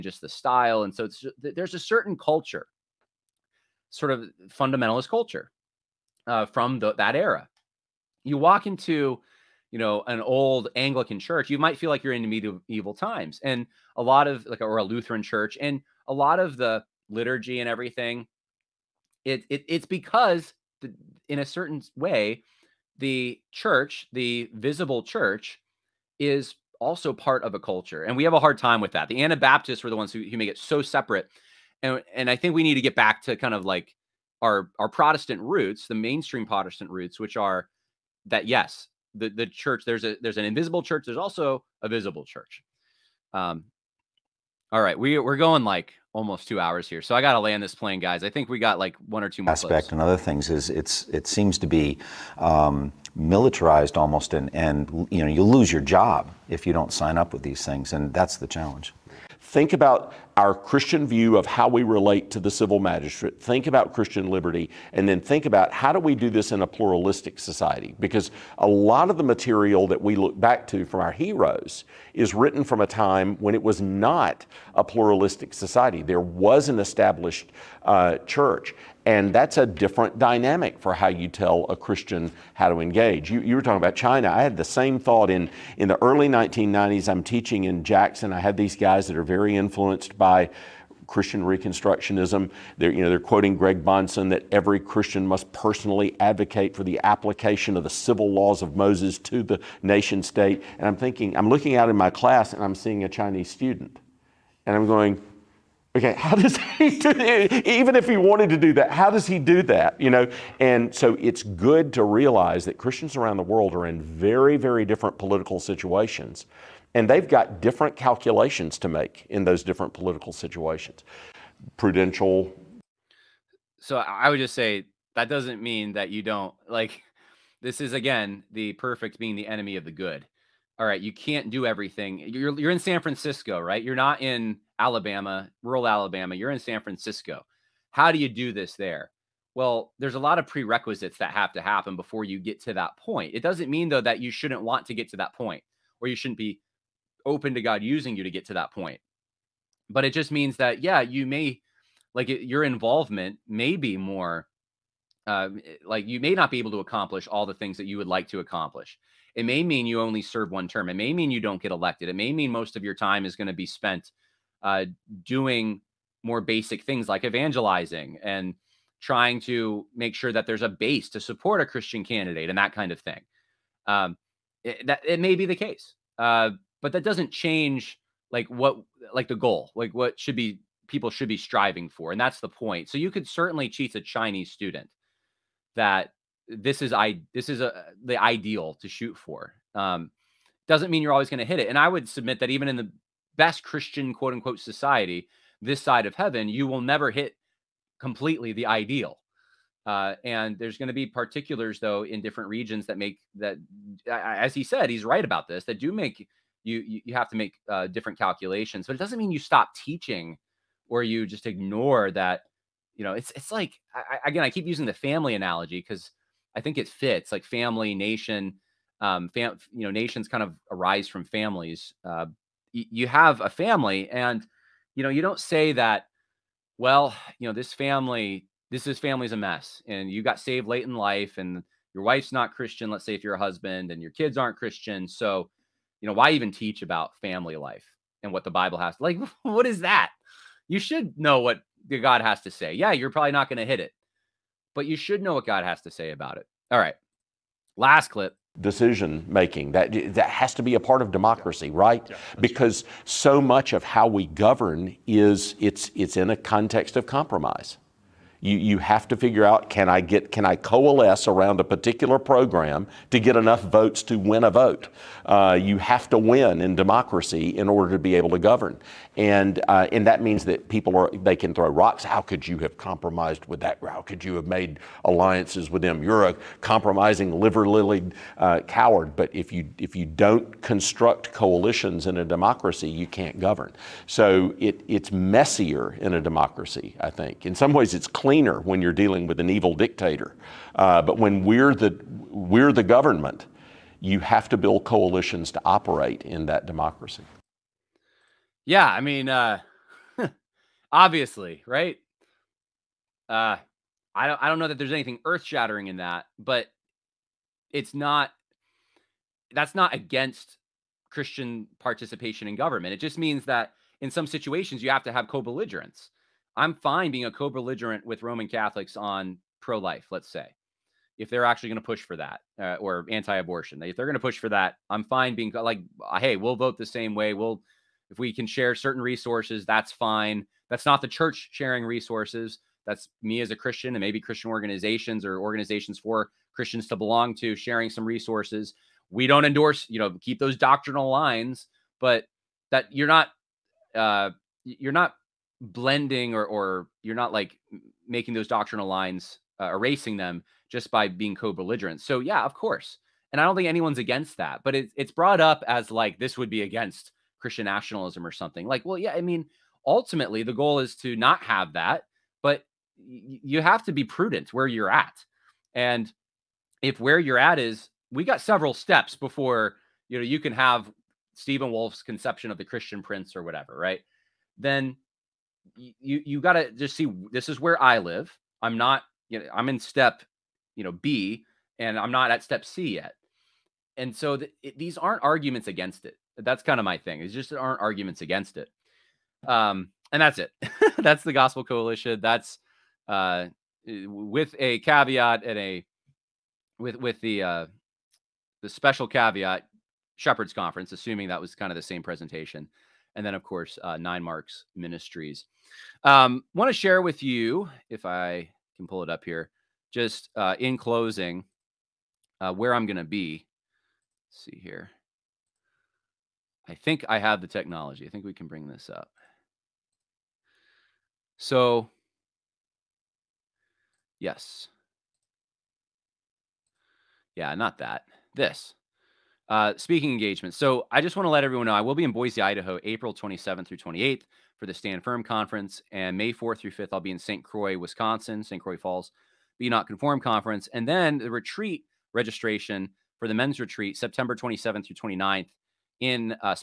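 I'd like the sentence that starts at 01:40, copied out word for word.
And I'm thinking, I'm looking out in my class and I'm seeing a Chinese student.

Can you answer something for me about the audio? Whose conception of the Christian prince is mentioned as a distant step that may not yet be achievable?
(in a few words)
Stephen Wolfe.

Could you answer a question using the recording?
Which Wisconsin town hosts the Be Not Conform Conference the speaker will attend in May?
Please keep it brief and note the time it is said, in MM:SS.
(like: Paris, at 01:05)
St. Croix Falls, at 07:18.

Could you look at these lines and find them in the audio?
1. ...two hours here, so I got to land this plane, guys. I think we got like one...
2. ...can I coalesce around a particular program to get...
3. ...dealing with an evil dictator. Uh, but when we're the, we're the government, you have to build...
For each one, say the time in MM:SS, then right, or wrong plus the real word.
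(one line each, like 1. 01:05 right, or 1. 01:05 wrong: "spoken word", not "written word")
1. 00:46 right
2. 04:20 right
3. 04:48 right.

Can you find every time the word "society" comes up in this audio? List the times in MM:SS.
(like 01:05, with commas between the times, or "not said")
01:07, 01:15, 03:14.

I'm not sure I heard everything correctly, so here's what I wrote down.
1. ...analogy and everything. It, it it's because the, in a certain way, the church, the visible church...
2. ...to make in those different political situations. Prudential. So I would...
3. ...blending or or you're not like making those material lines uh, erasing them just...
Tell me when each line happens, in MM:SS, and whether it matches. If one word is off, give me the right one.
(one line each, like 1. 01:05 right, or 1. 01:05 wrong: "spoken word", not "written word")
1. 00:17 wrong: "liturgy", not "analogy"
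2. 01:58 right
3. 05:45 wrong: "doctrinal", not "material".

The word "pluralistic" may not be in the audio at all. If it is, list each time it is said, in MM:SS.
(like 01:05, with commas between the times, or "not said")
01:06, 01:14.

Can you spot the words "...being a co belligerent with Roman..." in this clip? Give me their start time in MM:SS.
05:17.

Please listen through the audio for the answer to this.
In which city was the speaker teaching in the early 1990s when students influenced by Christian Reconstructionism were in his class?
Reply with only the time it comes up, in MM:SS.
01:27.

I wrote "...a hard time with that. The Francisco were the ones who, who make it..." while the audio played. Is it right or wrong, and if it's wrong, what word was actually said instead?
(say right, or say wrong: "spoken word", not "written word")
wrong: "Anabaptists", not "Francisco".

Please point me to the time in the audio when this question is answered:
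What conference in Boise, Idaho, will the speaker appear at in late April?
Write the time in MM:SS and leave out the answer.
07:14.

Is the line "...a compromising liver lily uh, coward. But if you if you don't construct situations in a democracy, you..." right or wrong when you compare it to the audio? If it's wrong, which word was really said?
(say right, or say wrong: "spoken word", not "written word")
wrong: "coalitions", not "situations".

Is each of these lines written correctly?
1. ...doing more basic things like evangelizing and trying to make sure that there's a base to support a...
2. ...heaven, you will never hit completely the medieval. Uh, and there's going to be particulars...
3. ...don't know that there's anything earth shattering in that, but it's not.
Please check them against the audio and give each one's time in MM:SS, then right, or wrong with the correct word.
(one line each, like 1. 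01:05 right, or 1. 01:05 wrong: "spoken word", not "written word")
1. 02:45 right
2. 03:16 wrong: "ideal", not "medieval"
3. 05:04 right.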